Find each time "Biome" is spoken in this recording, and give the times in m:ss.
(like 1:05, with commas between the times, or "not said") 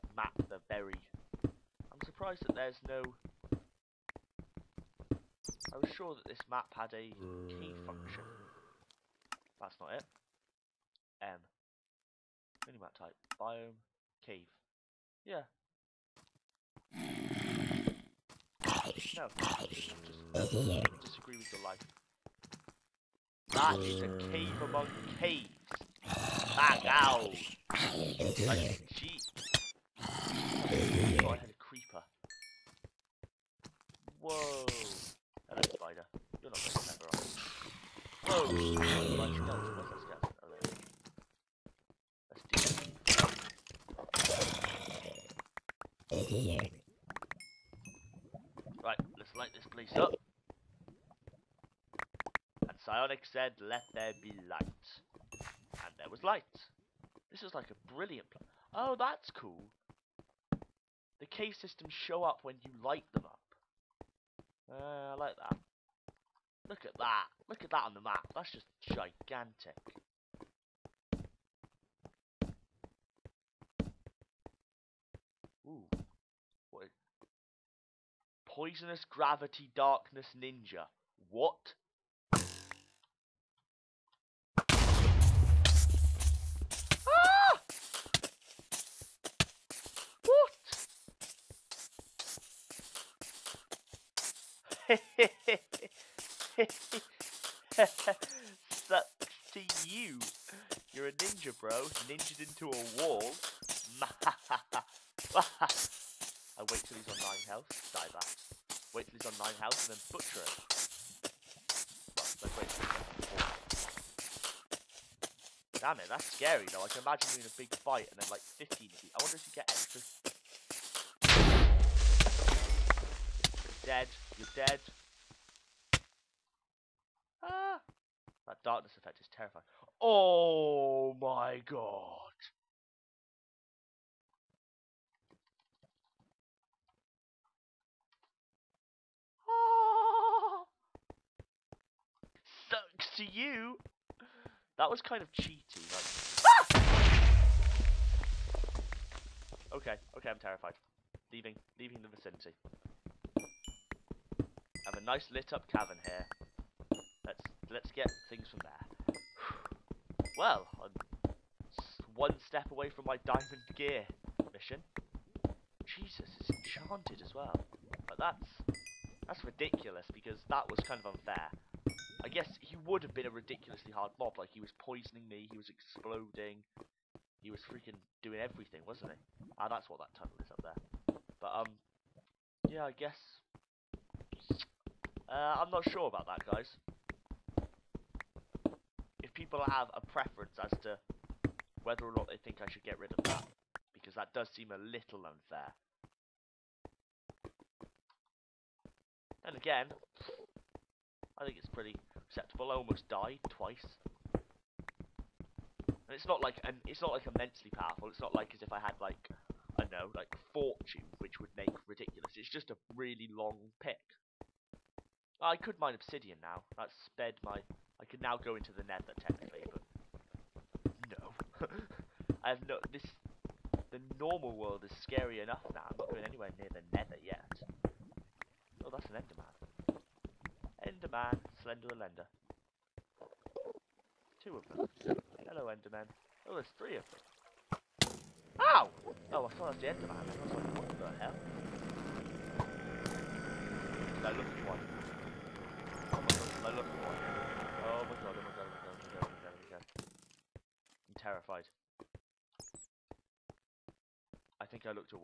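0:13.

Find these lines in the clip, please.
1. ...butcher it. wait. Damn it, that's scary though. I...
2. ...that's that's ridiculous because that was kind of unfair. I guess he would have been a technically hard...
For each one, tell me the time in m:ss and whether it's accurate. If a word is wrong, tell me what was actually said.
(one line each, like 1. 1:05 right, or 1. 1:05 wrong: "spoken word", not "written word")
1. 1:50 right
2. 2:48 wrong: "ridiculously", not "technically".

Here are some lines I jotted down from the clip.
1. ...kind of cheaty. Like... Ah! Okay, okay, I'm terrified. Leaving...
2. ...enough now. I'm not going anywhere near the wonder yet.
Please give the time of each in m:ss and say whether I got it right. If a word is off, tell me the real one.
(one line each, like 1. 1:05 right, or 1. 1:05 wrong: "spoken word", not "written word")
1. 2:25 right
2. 3:45 wrong: "nether", not "wonder".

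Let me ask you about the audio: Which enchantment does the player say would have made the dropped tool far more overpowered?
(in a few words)
Fortune.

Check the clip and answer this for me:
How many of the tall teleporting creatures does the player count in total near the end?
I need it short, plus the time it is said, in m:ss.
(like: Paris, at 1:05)
3, at 3:56.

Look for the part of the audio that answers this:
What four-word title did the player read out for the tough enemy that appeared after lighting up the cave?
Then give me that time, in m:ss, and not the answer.
1:18.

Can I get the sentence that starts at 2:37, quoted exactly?
Let's let's get things from there.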